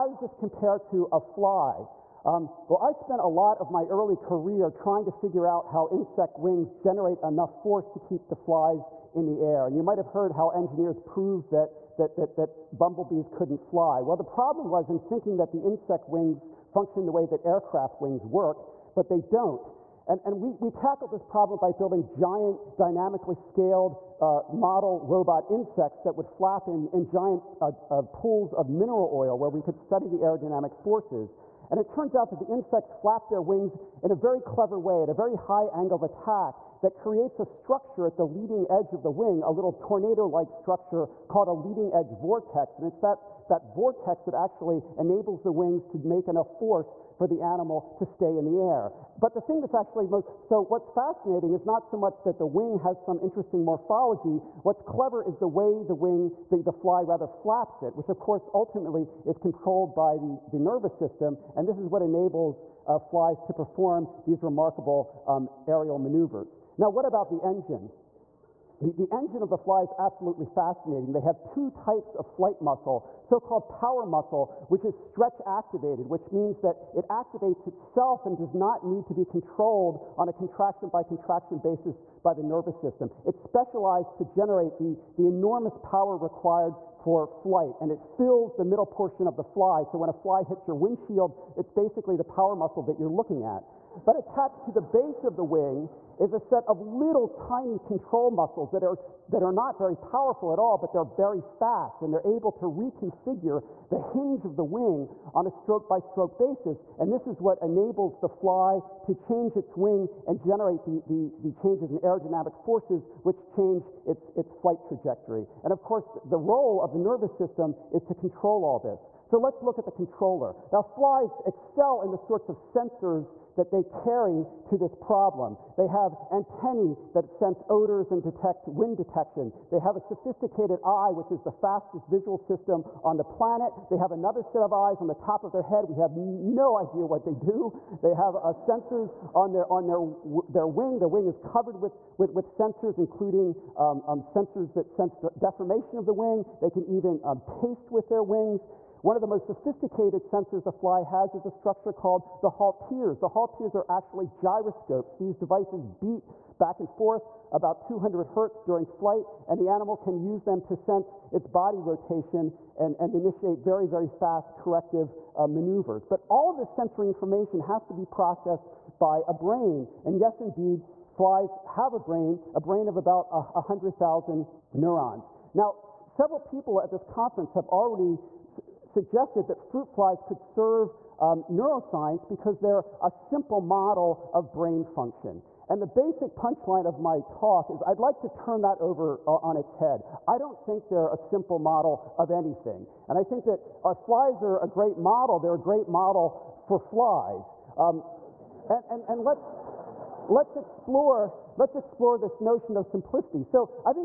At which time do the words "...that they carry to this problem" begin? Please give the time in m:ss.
2:03.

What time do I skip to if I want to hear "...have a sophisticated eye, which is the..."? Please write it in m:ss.
2:09.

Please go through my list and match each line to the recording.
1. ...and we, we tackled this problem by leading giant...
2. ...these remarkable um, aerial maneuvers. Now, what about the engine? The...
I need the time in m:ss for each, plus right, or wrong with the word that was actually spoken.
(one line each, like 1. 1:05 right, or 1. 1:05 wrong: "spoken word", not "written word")
1. 0:20 wrong: "building", not "leading"
2. 1:04 right.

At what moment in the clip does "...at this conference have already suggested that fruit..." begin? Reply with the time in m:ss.
2:56.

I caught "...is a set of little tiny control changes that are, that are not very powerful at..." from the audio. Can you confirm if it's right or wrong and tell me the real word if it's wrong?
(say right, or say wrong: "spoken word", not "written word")
wrong: "muscles", not "changes".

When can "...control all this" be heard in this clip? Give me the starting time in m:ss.
1:58.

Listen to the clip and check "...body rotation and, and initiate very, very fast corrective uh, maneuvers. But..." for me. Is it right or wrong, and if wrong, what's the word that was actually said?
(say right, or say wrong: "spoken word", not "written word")
right.